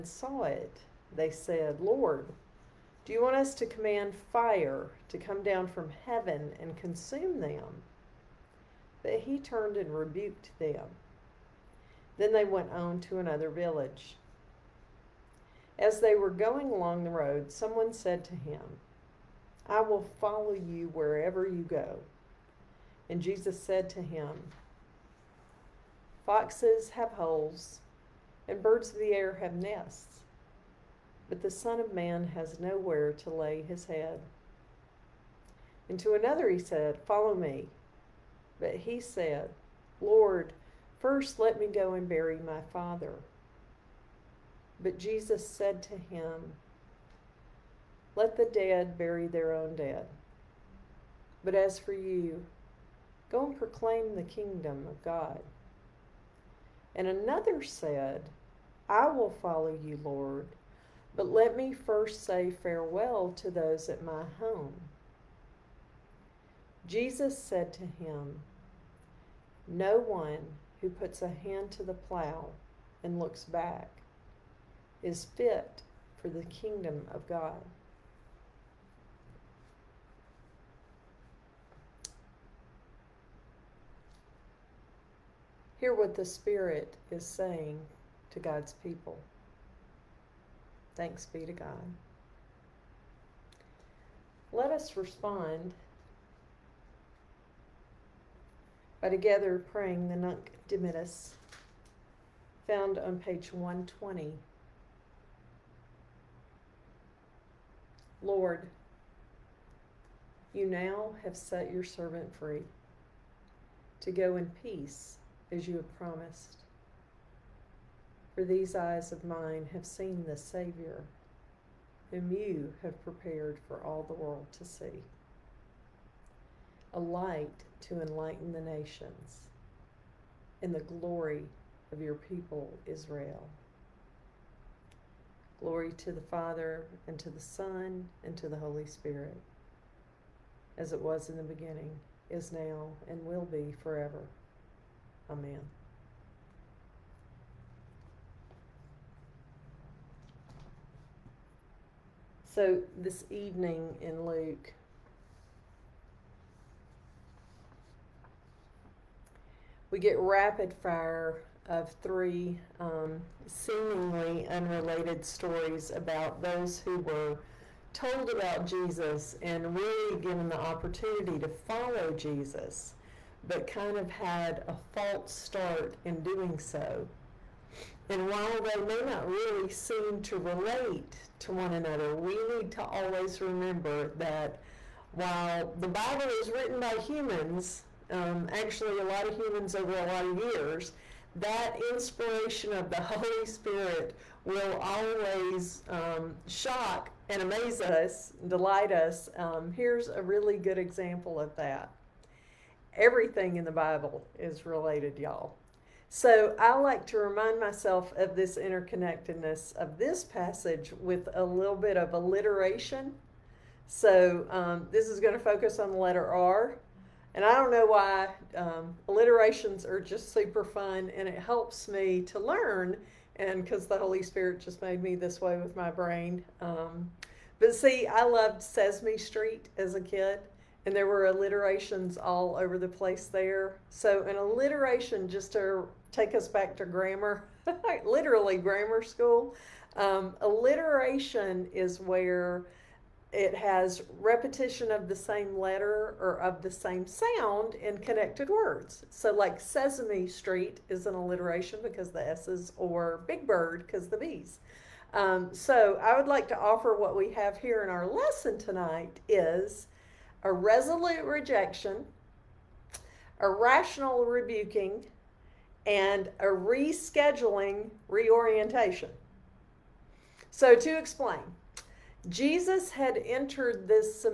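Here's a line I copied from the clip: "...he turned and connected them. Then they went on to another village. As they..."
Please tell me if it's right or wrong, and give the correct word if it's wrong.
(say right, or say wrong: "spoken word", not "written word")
wrong: "rebuked", not "connected".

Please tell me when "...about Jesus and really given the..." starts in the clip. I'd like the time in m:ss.
2:48.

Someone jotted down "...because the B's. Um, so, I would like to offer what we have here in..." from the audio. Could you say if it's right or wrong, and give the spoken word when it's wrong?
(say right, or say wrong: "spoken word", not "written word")
right.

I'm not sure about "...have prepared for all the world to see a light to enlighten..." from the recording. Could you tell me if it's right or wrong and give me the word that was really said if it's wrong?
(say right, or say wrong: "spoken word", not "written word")
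right.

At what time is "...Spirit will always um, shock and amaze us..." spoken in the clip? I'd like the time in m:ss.
3:13.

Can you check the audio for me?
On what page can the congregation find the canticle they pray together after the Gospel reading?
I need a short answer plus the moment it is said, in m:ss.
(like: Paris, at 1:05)
120, at 1:43.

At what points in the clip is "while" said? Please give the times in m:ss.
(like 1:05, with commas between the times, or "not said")
2:58, 3:05.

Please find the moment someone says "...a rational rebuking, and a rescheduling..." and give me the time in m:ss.
4:23.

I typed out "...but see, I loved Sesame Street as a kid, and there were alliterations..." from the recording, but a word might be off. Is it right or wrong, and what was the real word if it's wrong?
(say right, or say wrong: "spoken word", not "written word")
right.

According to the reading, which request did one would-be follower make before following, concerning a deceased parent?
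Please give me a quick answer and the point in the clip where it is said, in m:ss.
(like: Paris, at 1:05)
bury my father, at 0:42.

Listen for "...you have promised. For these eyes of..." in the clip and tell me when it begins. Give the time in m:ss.
1:55.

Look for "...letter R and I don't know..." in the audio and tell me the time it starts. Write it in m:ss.
3:35.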